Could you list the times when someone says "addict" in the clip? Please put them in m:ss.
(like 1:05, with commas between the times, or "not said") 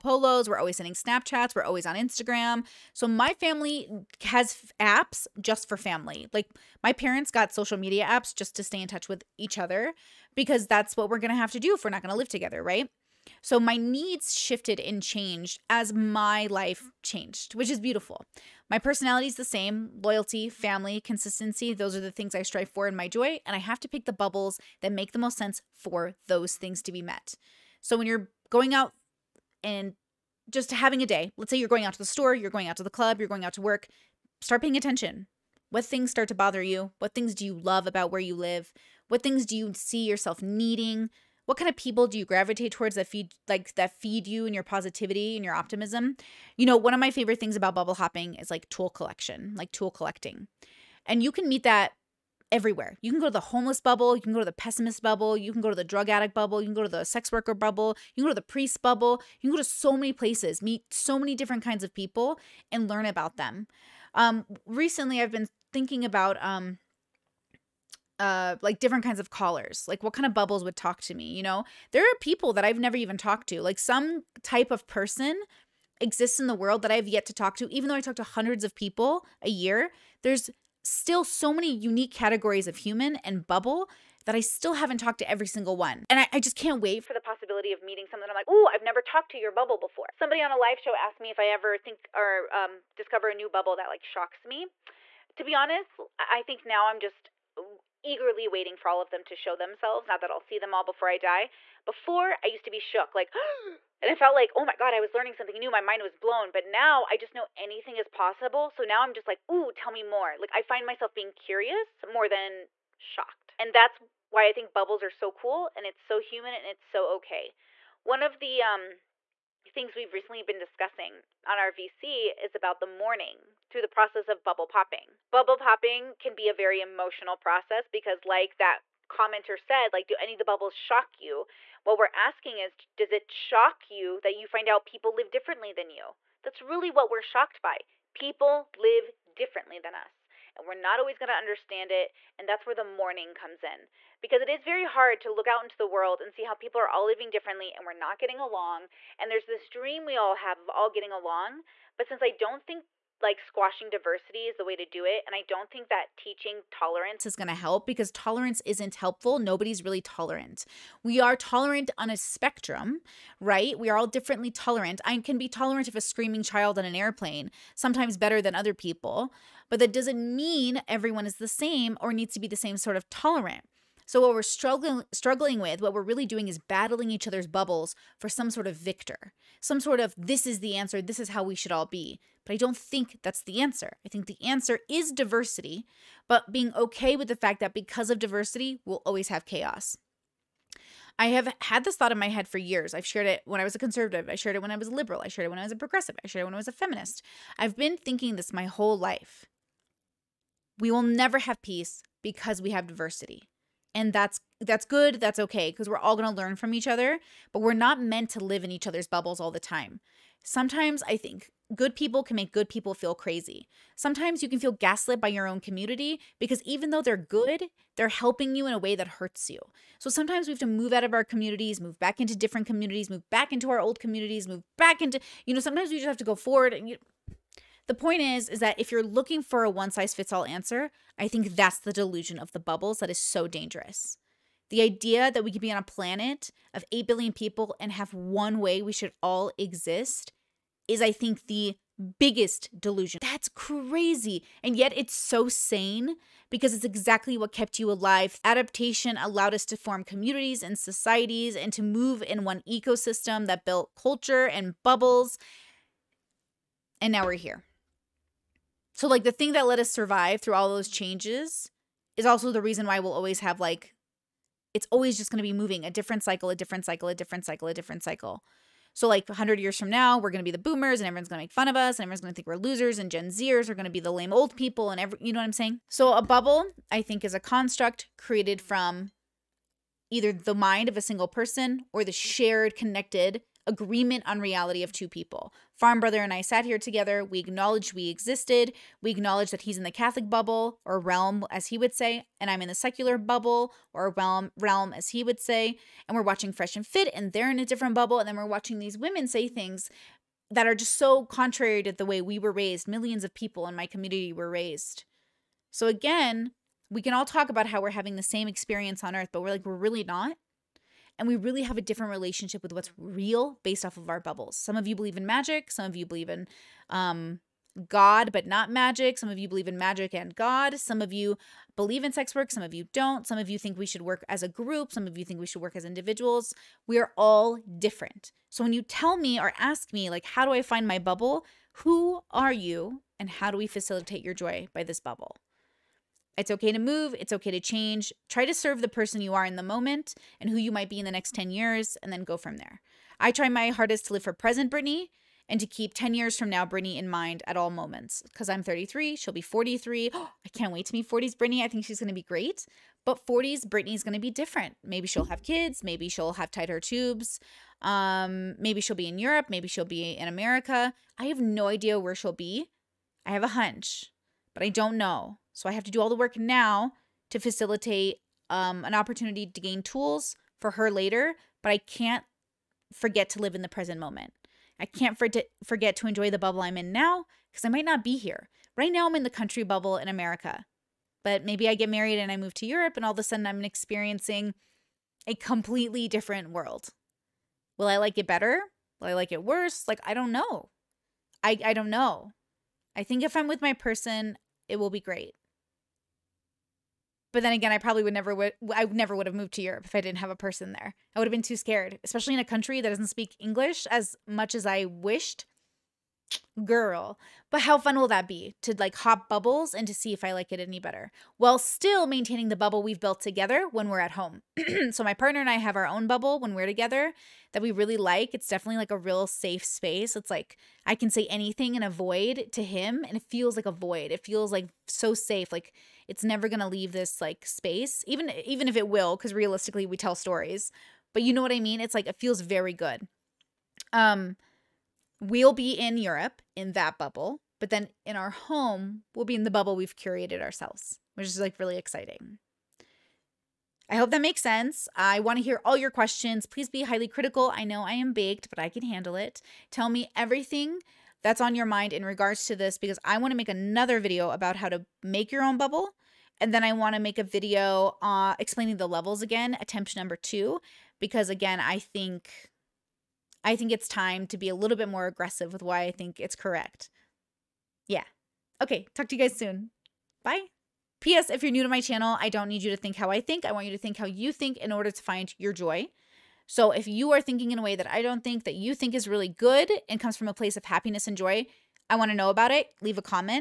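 0:56.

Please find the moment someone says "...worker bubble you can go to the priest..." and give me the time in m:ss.
0:57.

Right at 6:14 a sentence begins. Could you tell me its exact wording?
I can't for forget to enjoy the bubble I'm in now because I might not be here.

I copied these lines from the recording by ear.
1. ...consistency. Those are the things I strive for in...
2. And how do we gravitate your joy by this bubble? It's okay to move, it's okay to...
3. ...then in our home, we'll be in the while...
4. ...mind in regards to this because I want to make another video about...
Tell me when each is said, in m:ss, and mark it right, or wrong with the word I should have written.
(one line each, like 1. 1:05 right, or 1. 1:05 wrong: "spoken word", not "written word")
1. 0:20 right
2. 5:33 wrong: "facilitate", not "gravitate"
3. 7:17 wrong: "bubble", not "while"
4. 7:31 right.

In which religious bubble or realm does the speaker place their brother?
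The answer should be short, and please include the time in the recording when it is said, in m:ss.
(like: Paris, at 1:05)
Catholic, at 4:49.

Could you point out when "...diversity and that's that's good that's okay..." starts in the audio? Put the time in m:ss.
3:22.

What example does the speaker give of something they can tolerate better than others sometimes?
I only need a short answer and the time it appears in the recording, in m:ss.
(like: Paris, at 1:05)
a screaming child on an airplane, at 2:45.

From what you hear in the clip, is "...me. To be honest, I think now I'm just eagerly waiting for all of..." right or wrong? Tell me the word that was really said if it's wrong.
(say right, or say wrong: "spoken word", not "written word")
right.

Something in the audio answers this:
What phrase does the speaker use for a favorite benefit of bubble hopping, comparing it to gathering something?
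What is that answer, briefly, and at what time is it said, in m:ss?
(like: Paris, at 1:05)
tool collecting, at 0:49.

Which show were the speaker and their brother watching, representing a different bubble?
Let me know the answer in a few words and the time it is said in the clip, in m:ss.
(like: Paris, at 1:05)
Fresh and Fit, at 4:56.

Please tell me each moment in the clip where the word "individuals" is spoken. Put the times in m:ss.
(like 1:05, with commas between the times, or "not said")
5:25.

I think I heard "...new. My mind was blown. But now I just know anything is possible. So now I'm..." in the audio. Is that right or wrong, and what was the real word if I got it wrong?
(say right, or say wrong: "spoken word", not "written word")
right.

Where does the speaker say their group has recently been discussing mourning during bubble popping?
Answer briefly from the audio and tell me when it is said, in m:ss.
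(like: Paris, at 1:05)
on our VC, at 2:01.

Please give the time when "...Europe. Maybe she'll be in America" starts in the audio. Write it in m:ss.
5:59.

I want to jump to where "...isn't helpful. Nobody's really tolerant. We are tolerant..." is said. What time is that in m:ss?
2:38.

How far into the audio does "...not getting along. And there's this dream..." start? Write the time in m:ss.
2:27.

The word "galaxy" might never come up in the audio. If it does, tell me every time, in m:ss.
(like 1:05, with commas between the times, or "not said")
not said.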